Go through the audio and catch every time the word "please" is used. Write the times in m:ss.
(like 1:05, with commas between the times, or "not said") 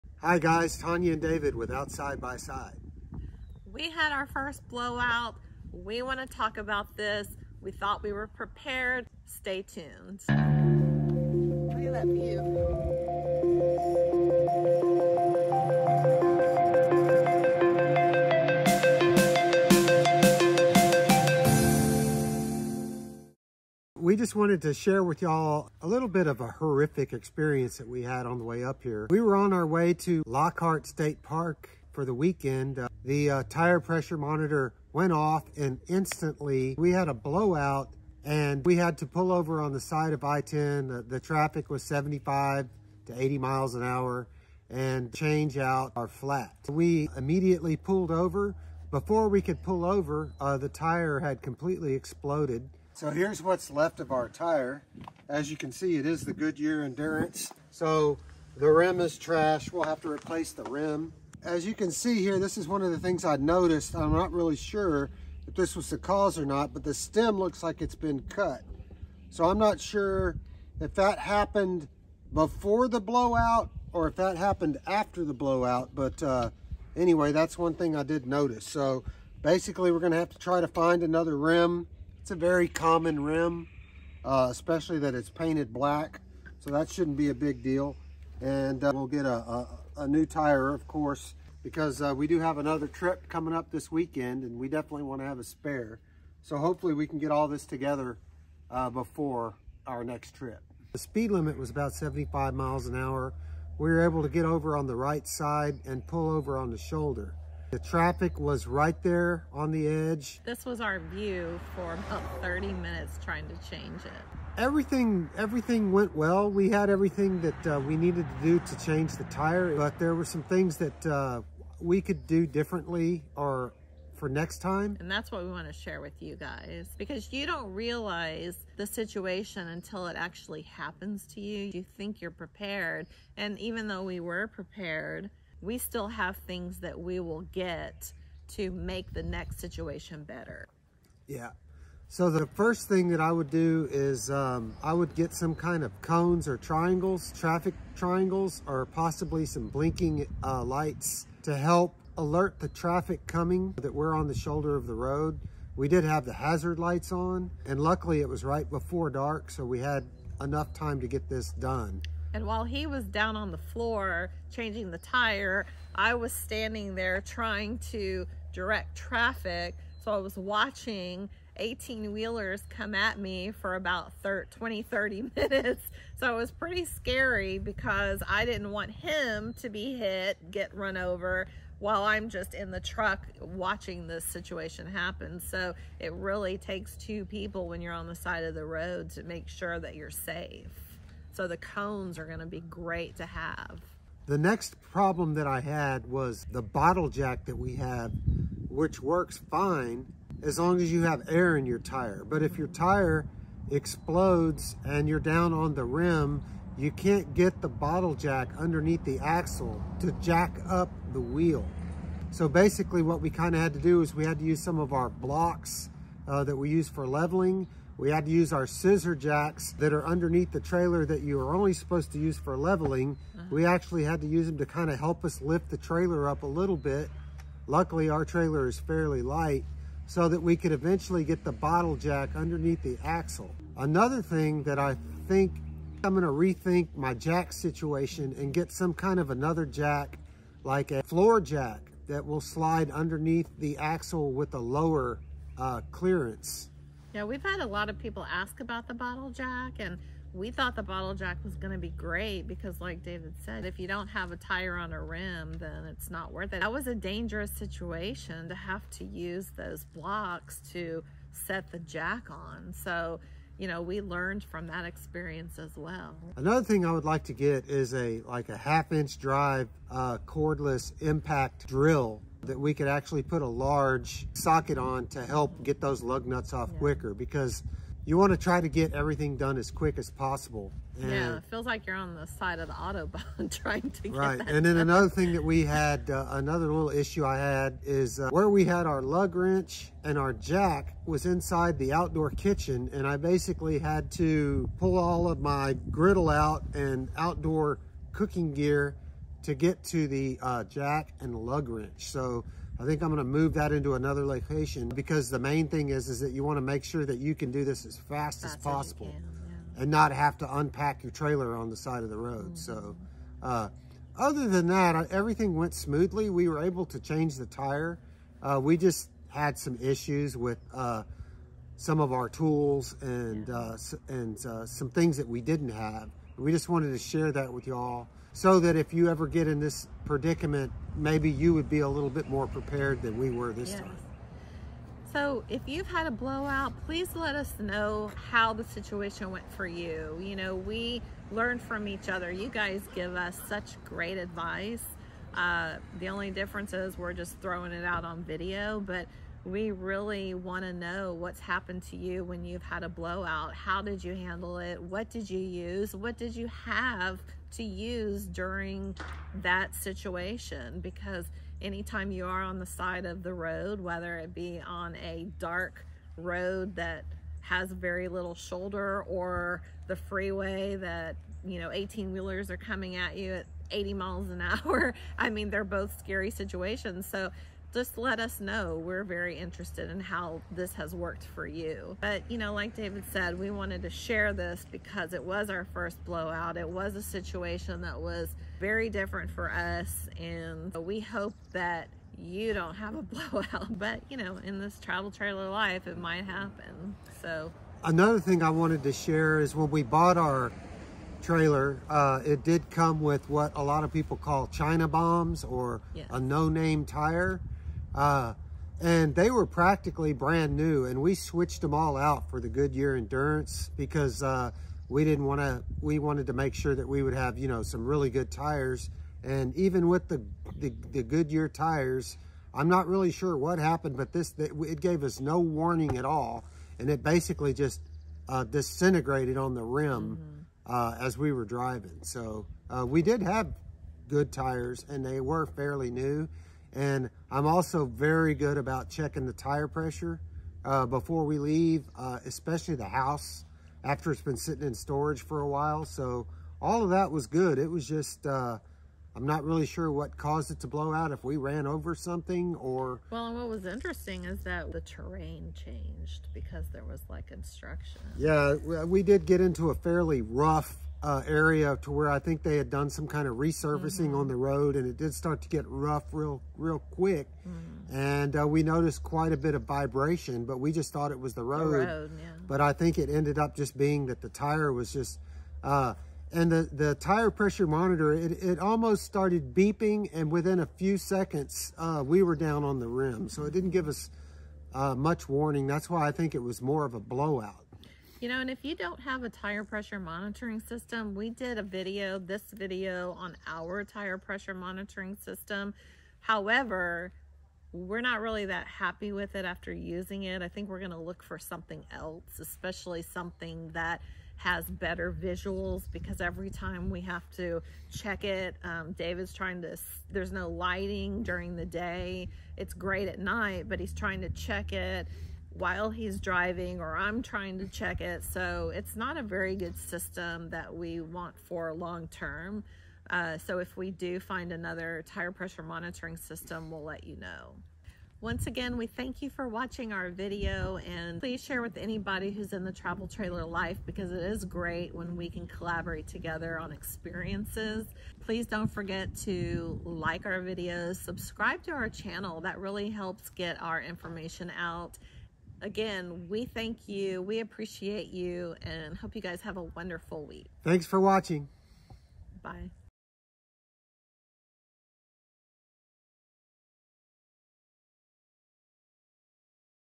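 5:36, 8:51, 8:58.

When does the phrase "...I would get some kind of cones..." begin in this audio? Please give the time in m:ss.
2:24.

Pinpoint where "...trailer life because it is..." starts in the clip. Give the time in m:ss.
8:53.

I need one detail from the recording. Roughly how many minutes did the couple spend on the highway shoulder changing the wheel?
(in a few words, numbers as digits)
30.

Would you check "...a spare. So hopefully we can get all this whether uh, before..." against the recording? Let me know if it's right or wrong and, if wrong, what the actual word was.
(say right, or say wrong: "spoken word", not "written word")
wrong: "together", not "whether".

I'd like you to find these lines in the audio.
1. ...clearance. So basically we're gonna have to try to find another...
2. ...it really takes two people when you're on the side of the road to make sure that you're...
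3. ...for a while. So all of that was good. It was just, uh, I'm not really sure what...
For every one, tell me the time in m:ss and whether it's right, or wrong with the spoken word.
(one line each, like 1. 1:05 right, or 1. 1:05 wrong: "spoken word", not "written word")
1. 1:18 wrong: "notice", not "clearance"
2. 3:05 right
3. 7:25 right.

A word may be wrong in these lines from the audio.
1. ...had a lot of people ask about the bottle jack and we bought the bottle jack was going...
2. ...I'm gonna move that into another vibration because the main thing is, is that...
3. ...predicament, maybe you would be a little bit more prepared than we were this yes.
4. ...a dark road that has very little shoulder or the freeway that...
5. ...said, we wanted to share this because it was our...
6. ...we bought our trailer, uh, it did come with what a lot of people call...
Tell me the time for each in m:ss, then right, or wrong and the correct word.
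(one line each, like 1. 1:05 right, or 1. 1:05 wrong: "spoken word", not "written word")
1. 4:07 wrong: "thought", not "bought"
2. 5:03 wrong: "location", not "vibration"
3. 5:30 right
4. 6:04 right
5. 6:23 right
6. 6:39 right.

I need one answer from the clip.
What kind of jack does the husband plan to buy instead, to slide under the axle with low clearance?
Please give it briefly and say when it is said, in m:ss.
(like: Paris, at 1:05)
Floor jack, at 4:01.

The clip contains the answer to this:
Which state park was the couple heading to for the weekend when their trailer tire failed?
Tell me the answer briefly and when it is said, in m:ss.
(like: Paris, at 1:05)
Lockhart State Park, at 0:30.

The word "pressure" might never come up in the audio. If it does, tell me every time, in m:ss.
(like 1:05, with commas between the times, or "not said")
0:33, 7:19, 7:57, 8:09, 8:14, 8:45.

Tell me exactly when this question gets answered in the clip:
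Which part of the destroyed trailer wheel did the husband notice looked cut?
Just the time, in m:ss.
1:06.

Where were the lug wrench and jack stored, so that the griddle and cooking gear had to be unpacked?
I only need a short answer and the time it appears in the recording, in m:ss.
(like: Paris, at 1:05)
Outdoor kitchen, at 4:51.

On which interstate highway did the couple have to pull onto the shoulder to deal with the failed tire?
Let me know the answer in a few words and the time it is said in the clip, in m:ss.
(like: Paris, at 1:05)
I-10, at 0:40.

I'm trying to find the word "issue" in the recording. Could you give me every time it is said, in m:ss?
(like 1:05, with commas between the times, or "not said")
4:46, 5:19.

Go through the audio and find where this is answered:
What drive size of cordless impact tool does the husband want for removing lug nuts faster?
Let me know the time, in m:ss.
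4:28.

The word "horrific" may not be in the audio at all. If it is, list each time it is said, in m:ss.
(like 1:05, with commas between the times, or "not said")
0:26.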